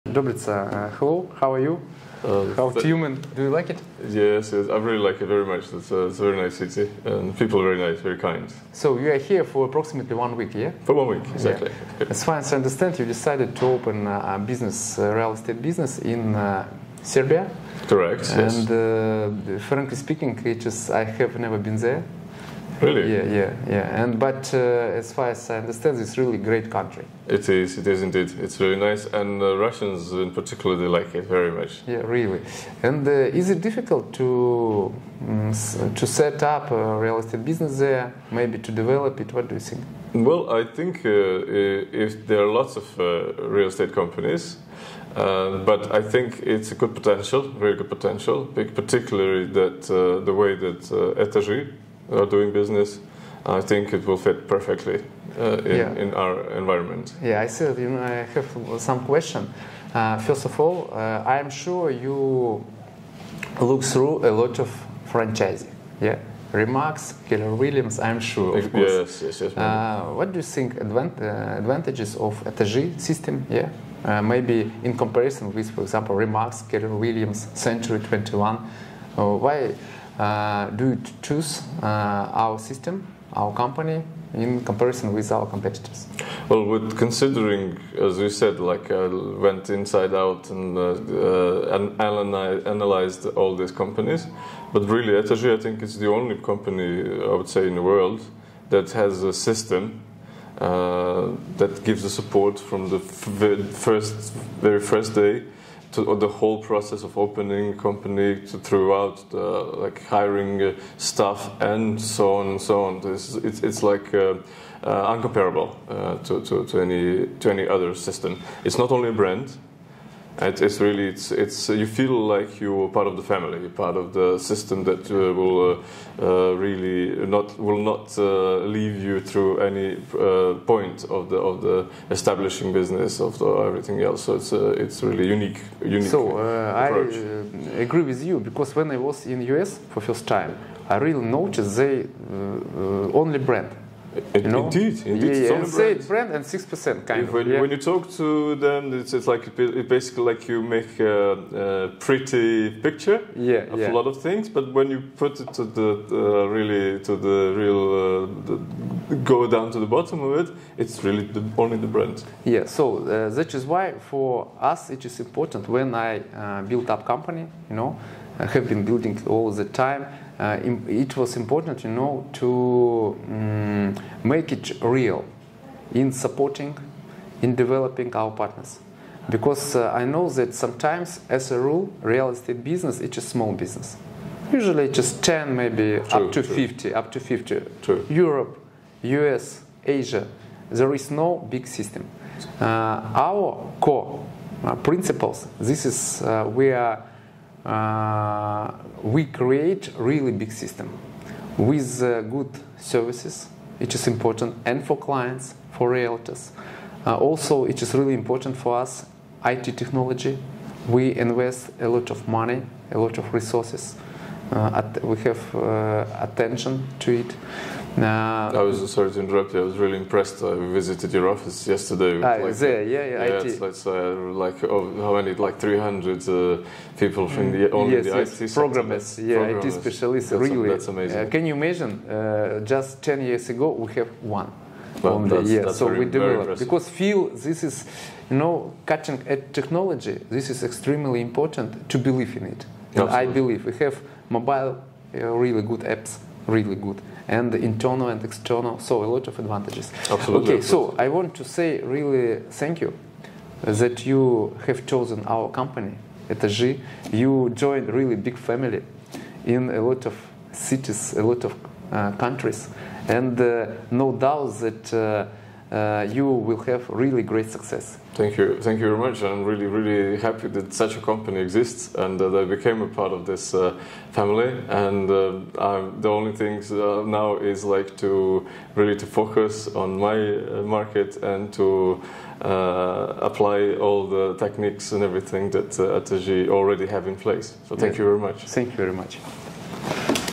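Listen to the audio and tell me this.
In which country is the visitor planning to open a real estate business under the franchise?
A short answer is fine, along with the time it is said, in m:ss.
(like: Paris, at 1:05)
Serbia, at 0:17.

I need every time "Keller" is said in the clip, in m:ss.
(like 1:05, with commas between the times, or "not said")
1:07, 1:16.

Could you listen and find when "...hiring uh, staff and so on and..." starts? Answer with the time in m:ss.
1:50.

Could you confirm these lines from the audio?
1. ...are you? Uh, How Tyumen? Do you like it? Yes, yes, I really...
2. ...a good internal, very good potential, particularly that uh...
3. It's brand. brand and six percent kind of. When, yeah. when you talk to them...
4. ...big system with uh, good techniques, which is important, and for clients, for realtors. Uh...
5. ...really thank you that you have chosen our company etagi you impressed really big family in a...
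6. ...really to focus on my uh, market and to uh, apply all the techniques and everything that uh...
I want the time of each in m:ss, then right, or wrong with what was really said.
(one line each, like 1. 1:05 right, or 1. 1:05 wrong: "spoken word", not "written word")
1. 0:01 right
2. 0:46 wrong: "potential", not "internal"
3. 2:25 right
4. 3:20 wrong: "services", not "techniques"
5. 4:11 wrong: "joined", not "impressed"
6. 4:38 right.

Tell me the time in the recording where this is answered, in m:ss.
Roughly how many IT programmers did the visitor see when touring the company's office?
3:45.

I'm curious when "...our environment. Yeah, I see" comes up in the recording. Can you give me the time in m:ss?
0:56.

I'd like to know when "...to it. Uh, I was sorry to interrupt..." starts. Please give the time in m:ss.
3:36.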